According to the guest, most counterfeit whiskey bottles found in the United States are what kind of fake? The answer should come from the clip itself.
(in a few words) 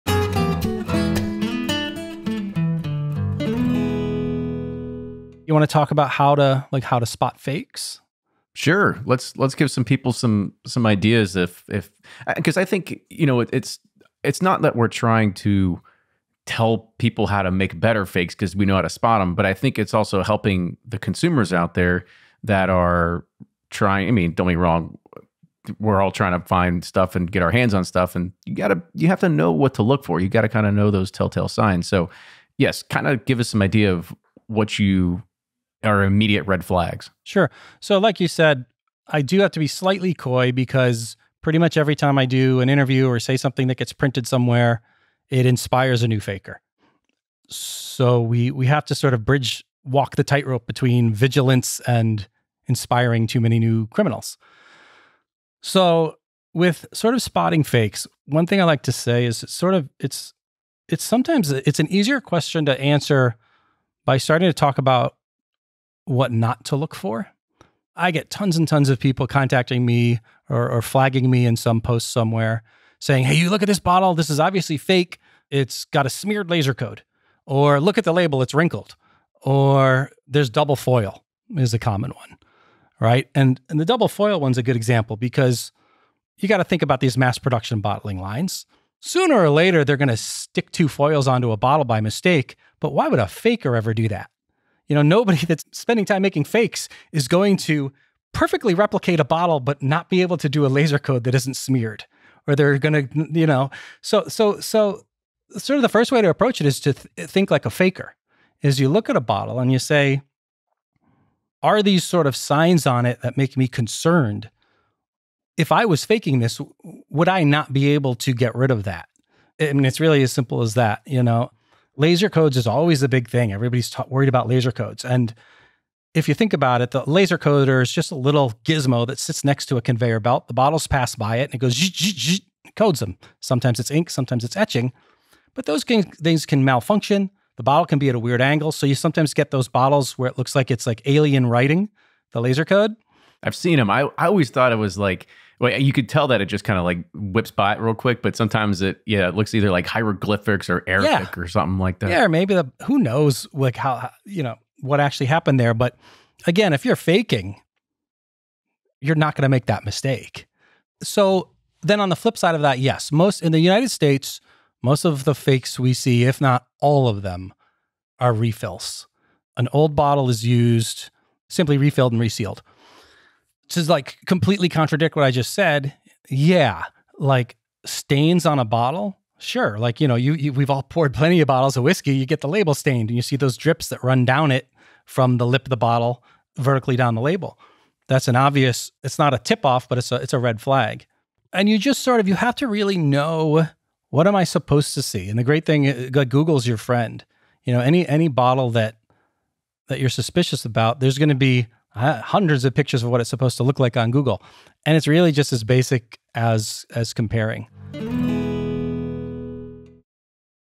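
Refills.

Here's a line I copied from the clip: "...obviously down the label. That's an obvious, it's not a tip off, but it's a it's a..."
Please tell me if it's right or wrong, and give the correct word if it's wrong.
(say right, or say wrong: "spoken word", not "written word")
wrong: "vertically", not "obviously".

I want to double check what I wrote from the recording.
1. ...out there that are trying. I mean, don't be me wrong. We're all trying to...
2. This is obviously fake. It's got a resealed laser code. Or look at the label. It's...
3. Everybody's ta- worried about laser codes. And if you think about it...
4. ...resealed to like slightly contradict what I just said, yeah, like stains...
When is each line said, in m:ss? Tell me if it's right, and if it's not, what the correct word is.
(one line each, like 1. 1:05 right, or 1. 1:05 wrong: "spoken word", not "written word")
1. 0:21 right
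2. 1:14 wrong: "smeared", not "resealed"
3. 2:03 right
4. 2:52 wrong: "completely", not "slightly".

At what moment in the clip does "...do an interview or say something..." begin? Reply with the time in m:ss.
0:42.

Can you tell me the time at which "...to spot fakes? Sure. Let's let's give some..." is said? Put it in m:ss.
0:06.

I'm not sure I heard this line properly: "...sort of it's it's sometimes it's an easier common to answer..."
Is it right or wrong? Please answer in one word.
wrong.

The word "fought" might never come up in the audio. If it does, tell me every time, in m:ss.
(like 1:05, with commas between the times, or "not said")
not said.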